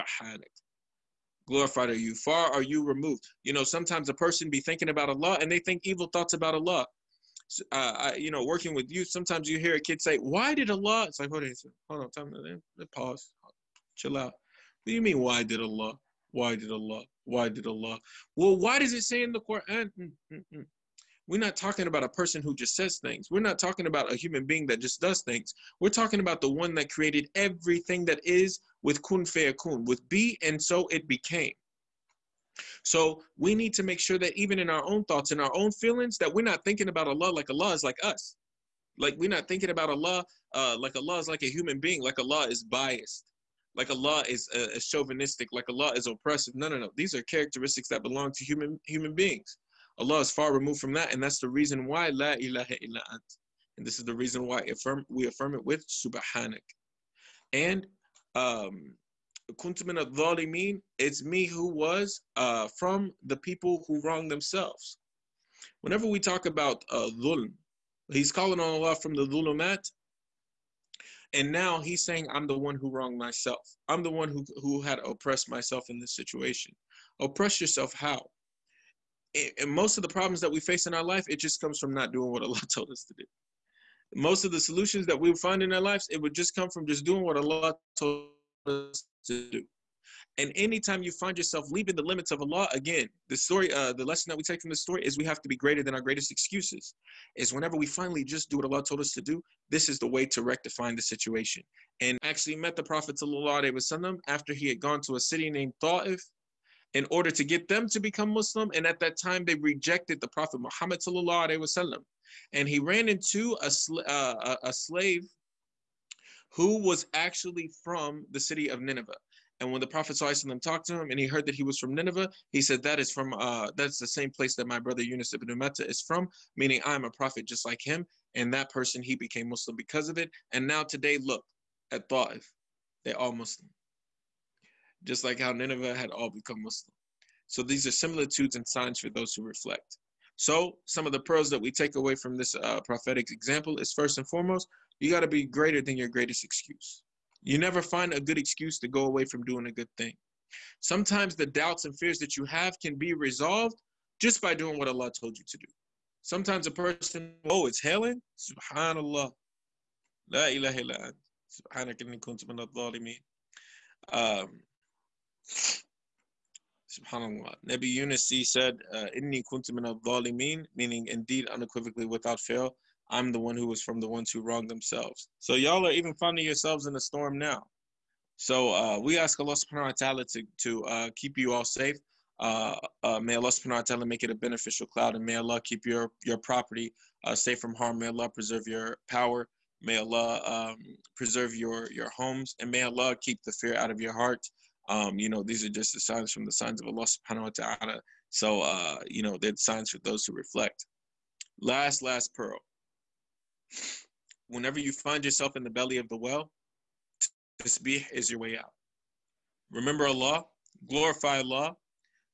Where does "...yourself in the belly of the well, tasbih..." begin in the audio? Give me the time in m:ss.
3:25.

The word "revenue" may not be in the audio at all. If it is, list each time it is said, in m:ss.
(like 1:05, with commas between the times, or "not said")
not said.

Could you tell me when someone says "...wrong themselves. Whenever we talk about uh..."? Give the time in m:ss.
1:04.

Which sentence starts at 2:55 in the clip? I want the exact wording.
So y'all are even finding yourselves in a storm now.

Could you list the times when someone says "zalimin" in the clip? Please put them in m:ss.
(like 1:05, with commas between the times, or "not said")
2:42, 2:49.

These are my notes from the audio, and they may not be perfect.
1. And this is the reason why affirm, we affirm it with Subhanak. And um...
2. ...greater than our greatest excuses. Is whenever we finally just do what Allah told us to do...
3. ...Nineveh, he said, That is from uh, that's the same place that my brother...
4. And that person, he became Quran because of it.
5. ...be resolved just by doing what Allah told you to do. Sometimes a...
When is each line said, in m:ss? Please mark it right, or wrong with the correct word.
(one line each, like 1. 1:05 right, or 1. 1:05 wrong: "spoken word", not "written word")
1. 0:53 right
2. 1:35 right
3. 2:01 right
4. 2:08 wrong: "Muslim", not "Quran"
5. 2:32 right.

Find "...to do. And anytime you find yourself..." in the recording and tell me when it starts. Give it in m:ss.
1:29.